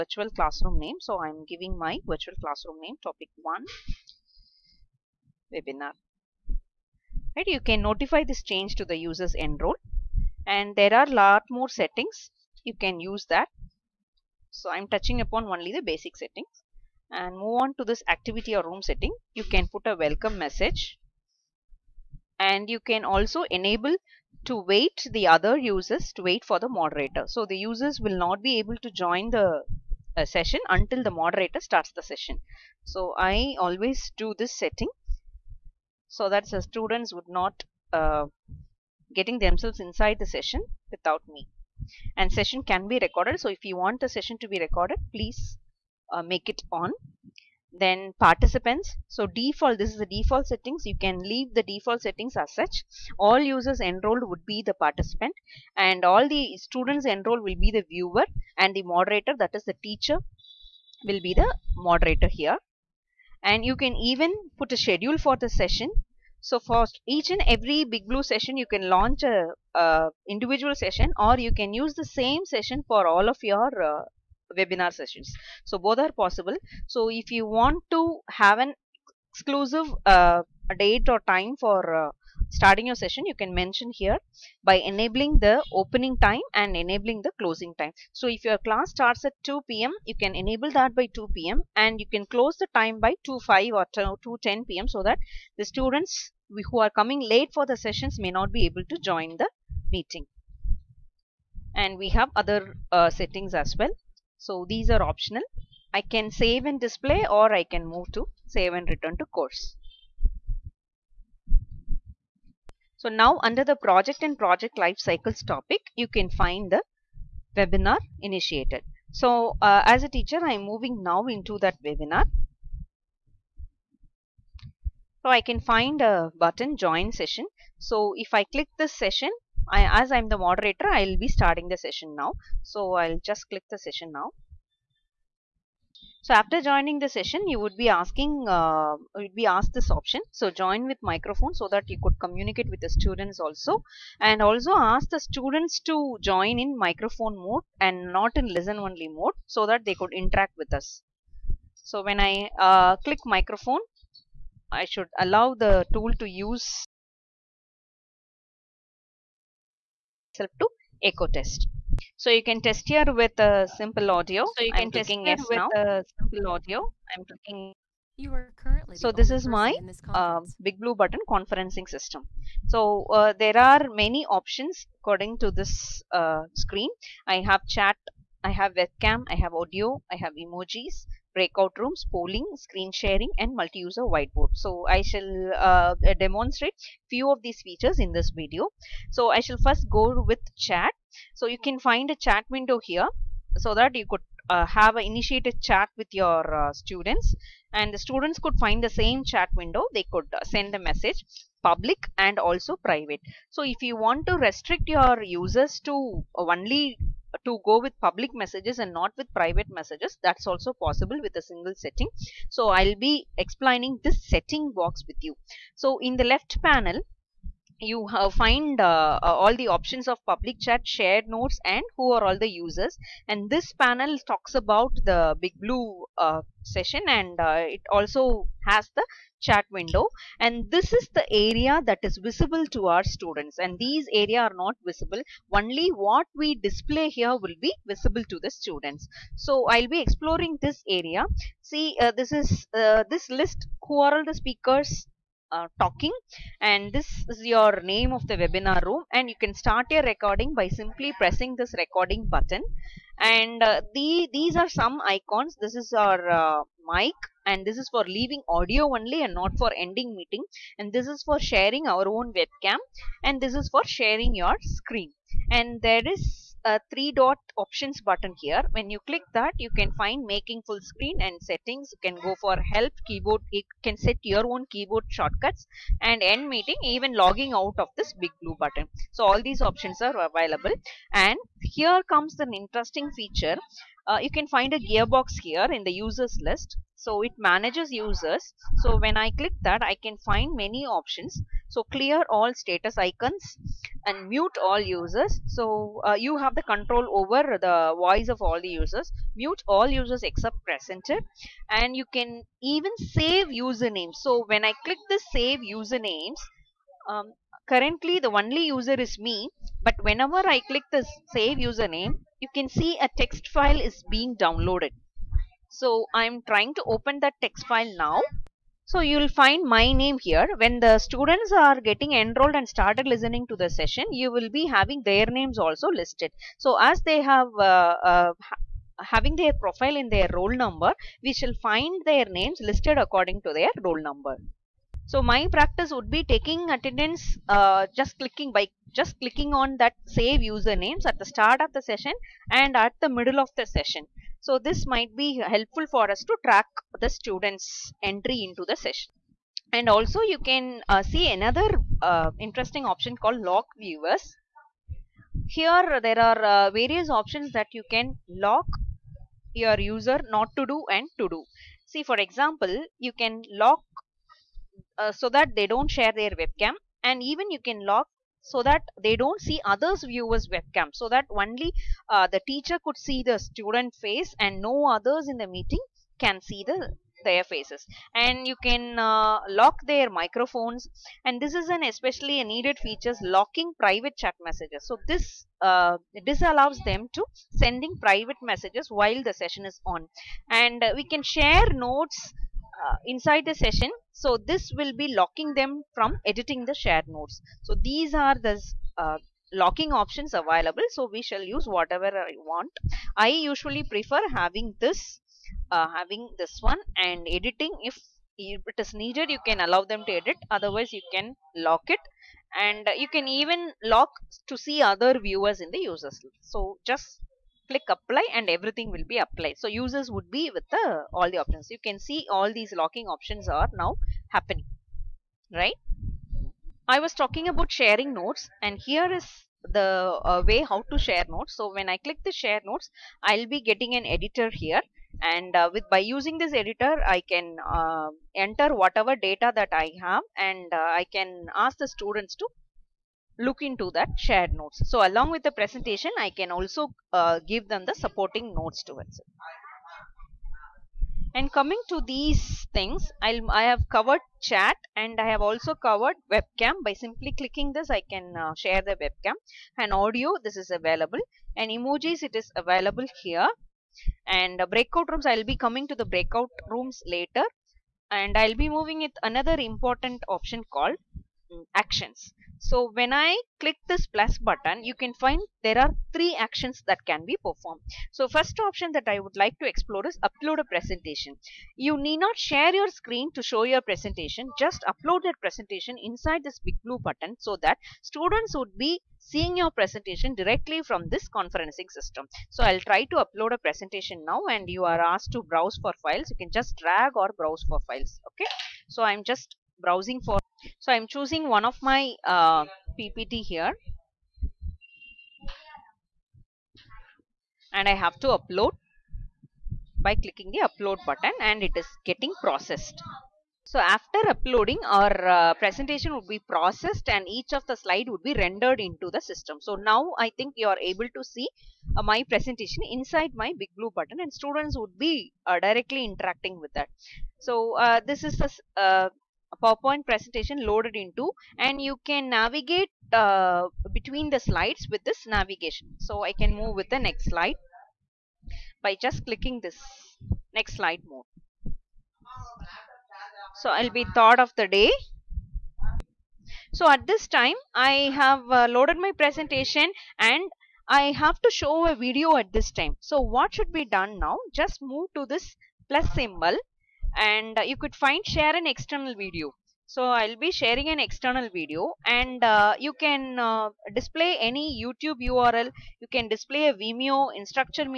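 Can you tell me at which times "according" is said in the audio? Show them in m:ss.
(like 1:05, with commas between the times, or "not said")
2:55, 5:32.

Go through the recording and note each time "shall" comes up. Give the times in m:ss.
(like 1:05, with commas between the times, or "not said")
3:05, 3:09, 5:31, 6:41.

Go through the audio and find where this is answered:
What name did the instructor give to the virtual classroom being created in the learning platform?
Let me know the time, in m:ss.
0:03.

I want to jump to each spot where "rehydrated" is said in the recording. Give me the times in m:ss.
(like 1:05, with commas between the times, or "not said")
not said.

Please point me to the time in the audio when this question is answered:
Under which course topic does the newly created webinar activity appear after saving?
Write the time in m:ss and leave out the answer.
1:53.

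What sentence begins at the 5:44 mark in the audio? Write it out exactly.
So this might be helpful for us to track the students entry into the session.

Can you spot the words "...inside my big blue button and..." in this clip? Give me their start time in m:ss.
8:42.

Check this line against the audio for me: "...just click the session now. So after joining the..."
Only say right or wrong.
right.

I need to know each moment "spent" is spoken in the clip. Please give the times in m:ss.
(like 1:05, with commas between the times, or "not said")
not said.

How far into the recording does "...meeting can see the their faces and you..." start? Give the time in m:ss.
6:15.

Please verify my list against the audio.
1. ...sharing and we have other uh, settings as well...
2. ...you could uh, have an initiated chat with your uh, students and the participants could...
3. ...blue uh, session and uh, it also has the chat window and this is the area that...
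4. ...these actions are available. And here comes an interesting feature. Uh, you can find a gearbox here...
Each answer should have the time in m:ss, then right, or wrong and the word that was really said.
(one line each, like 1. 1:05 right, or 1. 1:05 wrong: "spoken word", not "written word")
1. 1:39 wrong: "meeting", not "sharing"
2. 3:13 wrong: "students", not "participants"
3. 3:45 right
4. 4:39 wrong: "options", not "actions".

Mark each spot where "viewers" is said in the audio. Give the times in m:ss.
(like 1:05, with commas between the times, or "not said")
0:57, 5:53, 6:10, 6:55.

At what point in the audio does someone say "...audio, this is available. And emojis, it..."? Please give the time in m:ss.
7:39.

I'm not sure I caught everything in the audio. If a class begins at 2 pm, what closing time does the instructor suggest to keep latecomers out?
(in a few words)
2:10 pm.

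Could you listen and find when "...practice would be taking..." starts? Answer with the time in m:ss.
5:35.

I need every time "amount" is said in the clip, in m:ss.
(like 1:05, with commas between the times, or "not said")
not said.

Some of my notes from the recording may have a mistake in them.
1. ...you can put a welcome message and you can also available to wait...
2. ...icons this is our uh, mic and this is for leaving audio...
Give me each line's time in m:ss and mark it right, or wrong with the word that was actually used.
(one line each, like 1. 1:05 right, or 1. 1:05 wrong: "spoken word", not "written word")
1. 0:19 wrong: "enable", not "available"
2. 4:15 right.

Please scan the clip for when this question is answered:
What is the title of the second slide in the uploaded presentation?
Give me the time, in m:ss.
9:04.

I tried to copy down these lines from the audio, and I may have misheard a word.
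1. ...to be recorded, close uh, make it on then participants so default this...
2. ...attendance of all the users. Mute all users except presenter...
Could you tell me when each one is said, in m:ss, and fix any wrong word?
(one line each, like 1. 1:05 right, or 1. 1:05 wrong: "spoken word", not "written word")
1. 0:44 wrong: "please", not "close"
2. 4:57 wrong: "voice", not "attendance".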